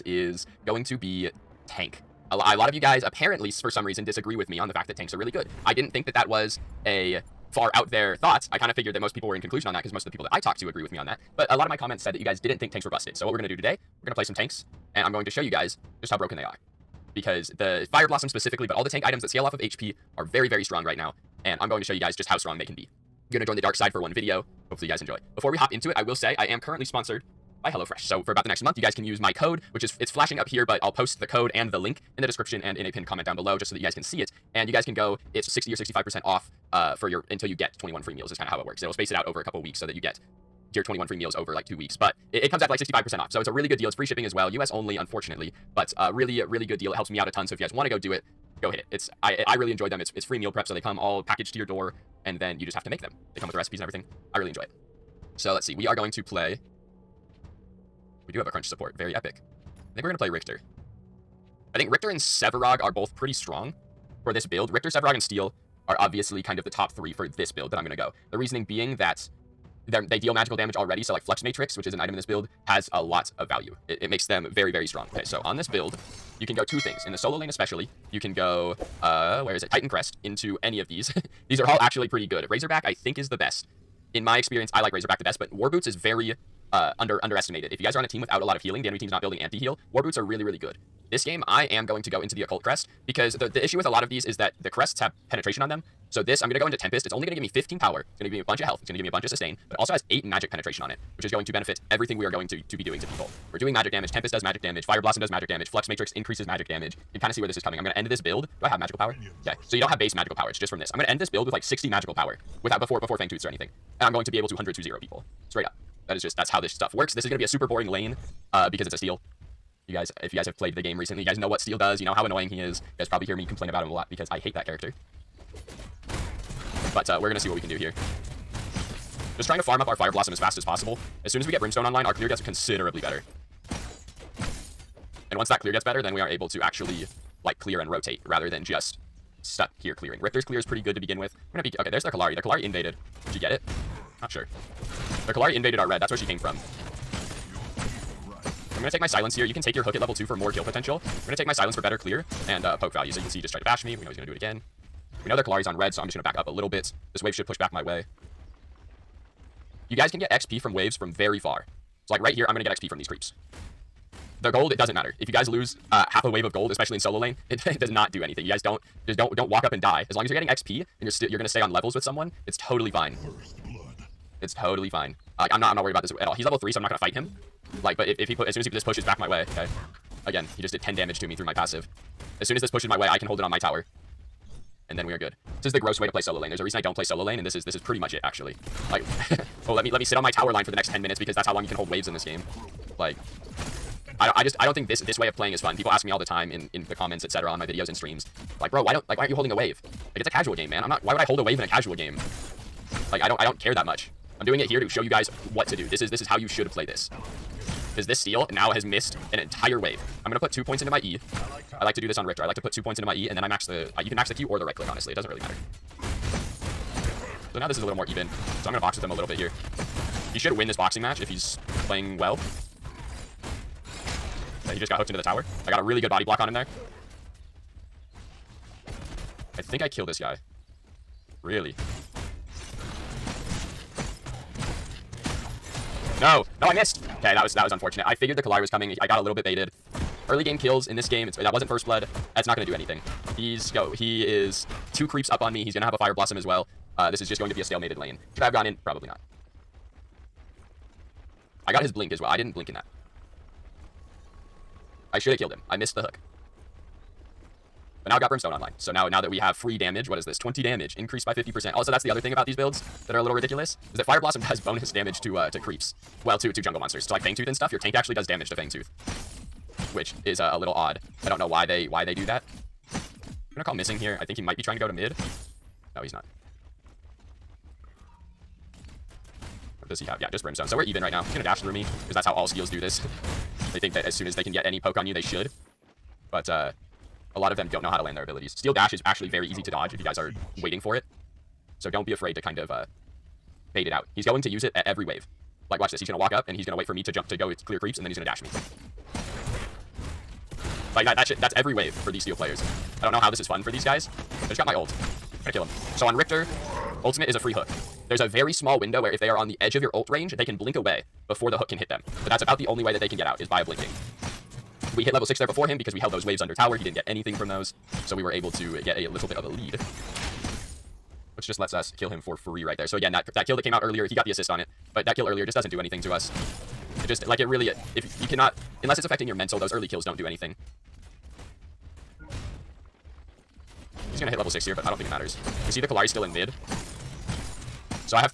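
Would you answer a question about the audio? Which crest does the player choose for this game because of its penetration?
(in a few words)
Occult Crest.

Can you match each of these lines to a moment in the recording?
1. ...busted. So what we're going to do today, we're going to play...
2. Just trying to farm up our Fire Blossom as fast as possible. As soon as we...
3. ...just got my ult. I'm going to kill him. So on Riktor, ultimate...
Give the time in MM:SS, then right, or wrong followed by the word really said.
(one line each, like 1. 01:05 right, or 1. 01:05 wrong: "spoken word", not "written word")
1. 00:12 right
2. 02:09 right
3. 05:04 right.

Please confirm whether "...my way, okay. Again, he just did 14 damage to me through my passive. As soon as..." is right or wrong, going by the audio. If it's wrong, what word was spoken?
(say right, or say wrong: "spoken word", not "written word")
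wrong: "10", not "14".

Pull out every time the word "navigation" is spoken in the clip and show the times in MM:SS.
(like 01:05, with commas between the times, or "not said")
not said.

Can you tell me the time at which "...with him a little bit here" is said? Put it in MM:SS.
03:38.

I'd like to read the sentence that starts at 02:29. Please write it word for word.
You can take your hook at level 2 for more kill potential.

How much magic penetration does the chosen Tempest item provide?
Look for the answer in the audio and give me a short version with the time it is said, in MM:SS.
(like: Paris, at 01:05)
8, at 01:40.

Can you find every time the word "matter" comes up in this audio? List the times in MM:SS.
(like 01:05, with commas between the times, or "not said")
02:44, 03:35, 05:35.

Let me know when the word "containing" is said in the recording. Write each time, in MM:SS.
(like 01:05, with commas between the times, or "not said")
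not said.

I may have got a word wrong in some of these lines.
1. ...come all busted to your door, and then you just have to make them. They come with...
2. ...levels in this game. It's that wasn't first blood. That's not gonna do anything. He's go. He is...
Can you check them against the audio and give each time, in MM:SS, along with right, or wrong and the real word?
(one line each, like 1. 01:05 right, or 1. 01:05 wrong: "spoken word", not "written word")
1. 00:50 wrong: "packaged", not "busted"
2. 04:00 wrong: "kills", not "levels".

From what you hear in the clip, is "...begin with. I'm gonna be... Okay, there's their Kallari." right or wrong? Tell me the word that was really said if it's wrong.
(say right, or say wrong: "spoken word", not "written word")
right.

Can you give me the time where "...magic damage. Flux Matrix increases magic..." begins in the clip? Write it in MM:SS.
01:45.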